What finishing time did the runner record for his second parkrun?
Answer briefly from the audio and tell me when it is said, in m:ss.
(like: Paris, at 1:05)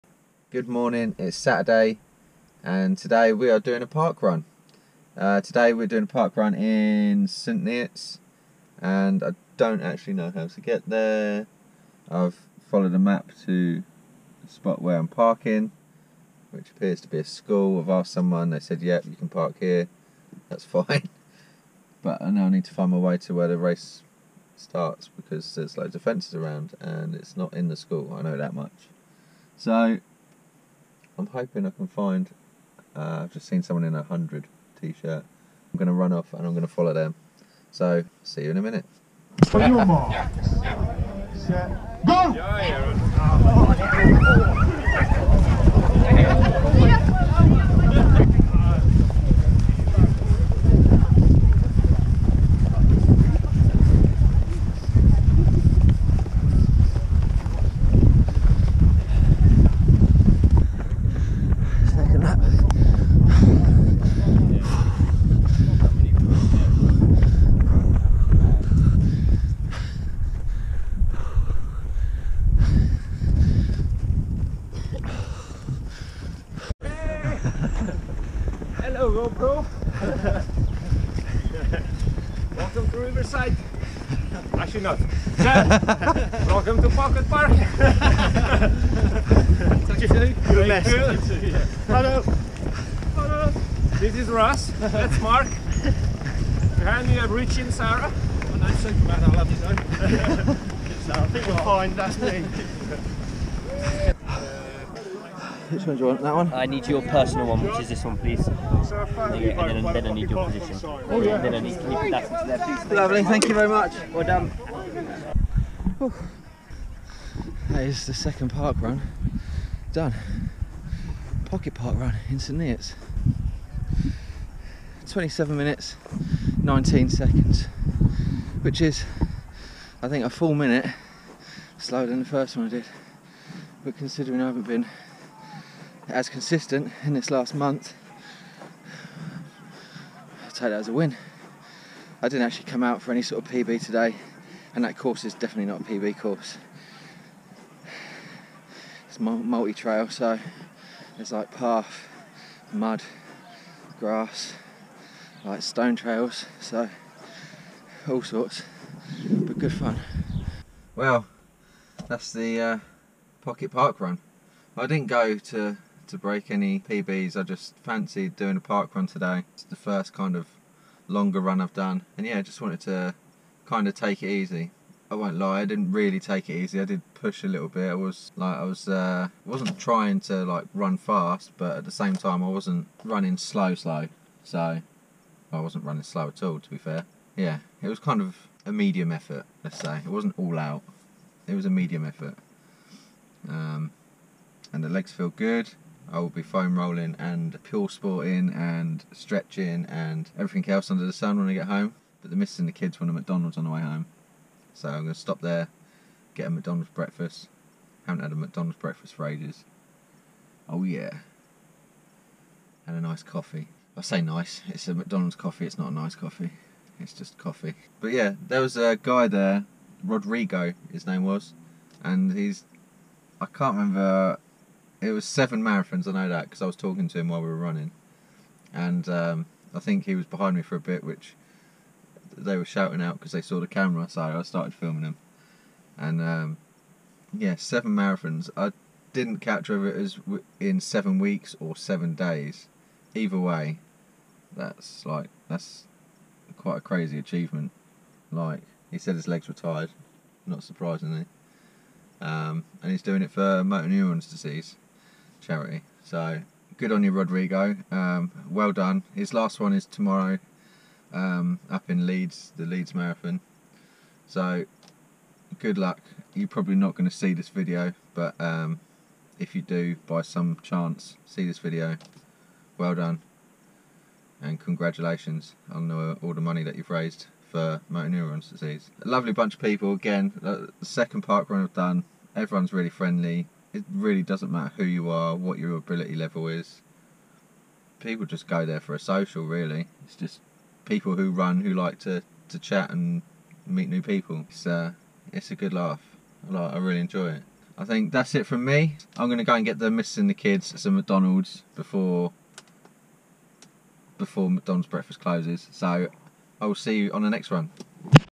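27 minutes, 19 seconds, at 2:05.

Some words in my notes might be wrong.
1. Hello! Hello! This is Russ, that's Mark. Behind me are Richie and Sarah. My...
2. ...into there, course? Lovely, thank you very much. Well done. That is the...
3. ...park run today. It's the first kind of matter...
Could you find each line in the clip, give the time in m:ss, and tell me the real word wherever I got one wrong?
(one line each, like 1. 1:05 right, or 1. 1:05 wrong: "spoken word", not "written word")
1. 1:31 right
2. 1:52 wrong: "please", not "course"
3. 2:48 wrong: "longer", not "matter".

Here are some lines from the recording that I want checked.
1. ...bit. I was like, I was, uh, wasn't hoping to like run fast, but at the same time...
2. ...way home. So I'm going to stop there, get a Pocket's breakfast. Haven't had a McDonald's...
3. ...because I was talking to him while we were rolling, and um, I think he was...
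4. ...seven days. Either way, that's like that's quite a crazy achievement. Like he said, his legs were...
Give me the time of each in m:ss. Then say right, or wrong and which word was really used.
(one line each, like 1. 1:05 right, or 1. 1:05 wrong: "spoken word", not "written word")
1. 2:57 wrong: "trying", not "hoping"
2. 3:23 wrong: "McDonald", not "Pocket"
3. 3:46 wrong: "running", not "rolling"
4. 4:01 right.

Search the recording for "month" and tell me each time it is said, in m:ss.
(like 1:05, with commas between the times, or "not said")
2:17.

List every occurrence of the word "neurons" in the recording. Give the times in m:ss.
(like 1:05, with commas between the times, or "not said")
4:13, 4:38.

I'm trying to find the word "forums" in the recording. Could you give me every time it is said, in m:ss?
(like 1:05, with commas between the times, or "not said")
not said.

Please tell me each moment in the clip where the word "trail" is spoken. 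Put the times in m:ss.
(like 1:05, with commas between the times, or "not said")
2:29, 2:35.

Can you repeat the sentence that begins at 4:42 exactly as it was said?
Everyone's really friendly it really doesn't matter who you are, what your ability level is.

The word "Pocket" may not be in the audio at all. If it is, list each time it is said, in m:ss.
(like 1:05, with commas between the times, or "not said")
1:26, 2:01, 2:43.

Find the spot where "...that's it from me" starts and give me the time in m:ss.
4:58.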